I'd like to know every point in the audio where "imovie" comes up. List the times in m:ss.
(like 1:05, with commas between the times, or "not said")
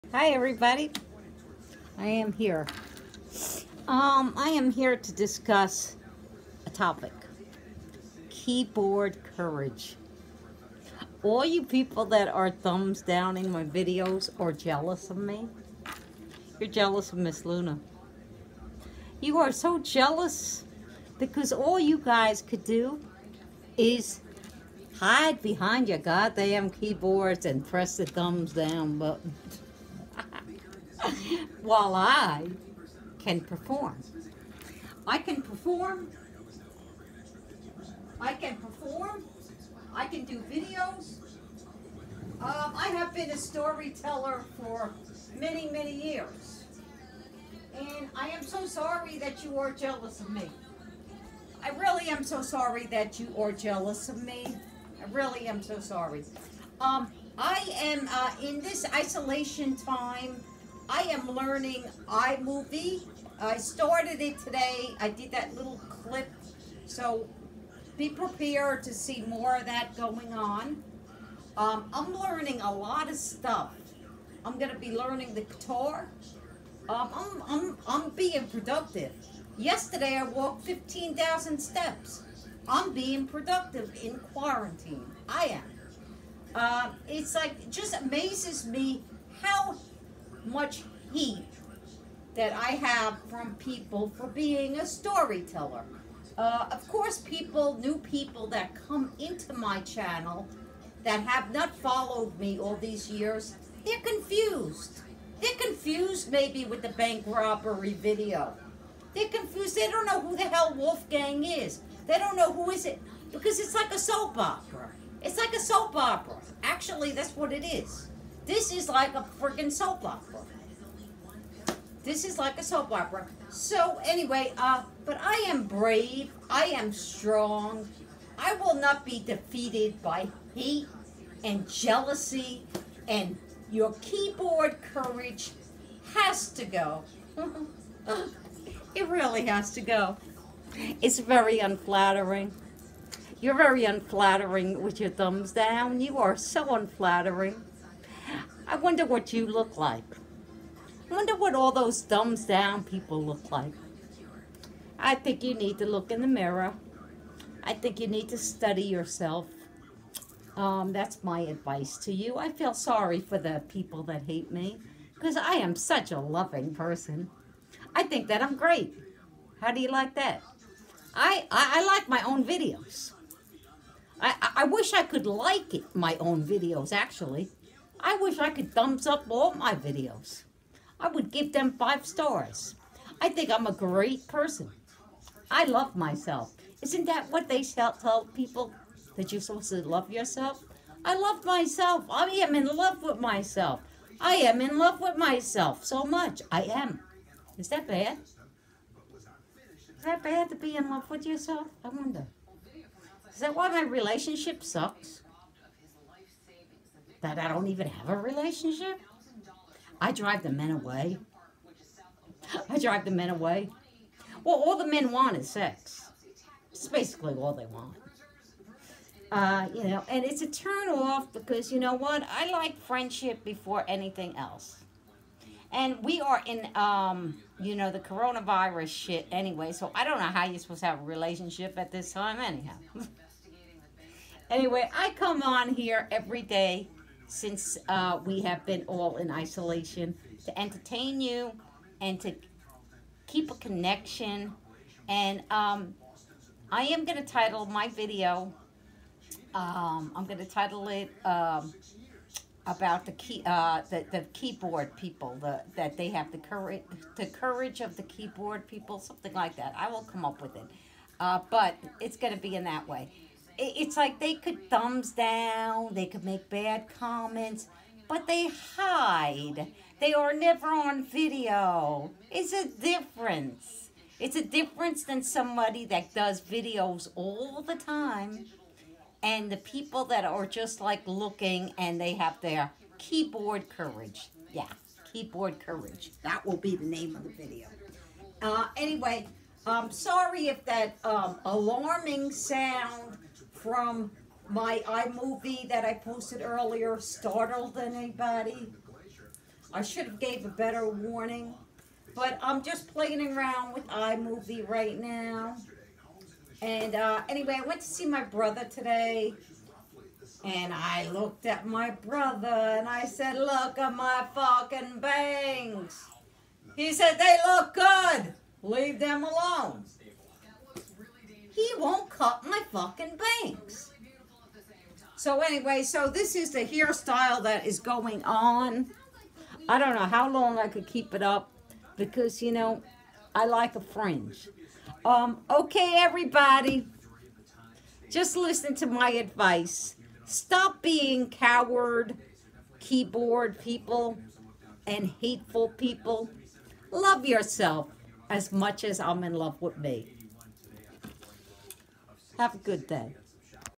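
1:02, 4:54, 5:03.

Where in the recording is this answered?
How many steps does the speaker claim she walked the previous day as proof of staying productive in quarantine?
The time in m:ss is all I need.
1:20.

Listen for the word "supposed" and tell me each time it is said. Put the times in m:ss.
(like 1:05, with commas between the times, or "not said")
3:09, 3:50.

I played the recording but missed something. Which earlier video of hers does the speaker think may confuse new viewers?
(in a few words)
the bank robbery video.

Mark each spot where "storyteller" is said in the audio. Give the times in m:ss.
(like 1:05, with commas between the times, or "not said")
0:43, 1:34.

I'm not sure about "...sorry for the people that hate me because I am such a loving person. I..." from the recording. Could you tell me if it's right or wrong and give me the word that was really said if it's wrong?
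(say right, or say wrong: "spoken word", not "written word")
right.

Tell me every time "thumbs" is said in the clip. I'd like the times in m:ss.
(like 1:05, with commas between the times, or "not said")
0:12, 0:28, 2:25, 2:32, 2:58, 4:24.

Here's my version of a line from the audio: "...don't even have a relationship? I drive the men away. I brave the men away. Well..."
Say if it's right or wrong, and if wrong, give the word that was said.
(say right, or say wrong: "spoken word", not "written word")
wrong: "drive", not "brave".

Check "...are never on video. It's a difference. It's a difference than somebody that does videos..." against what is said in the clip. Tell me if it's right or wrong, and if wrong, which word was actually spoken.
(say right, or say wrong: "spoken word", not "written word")
right.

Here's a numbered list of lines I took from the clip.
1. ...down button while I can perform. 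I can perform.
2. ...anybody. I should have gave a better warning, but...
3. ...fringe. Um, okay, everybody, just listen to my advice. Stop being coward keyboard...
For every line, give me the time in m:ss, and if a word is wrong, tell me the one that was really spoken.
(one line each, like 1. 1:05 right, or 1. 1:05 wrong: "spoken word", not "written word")
1. 0:28 right
2. 4:57 right
3. 5:33 right.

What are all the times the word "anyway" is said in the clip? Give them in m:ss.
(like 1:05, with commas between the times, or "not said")
2:04, 3:49, 3:54, 4:48, 5:07, 5:25.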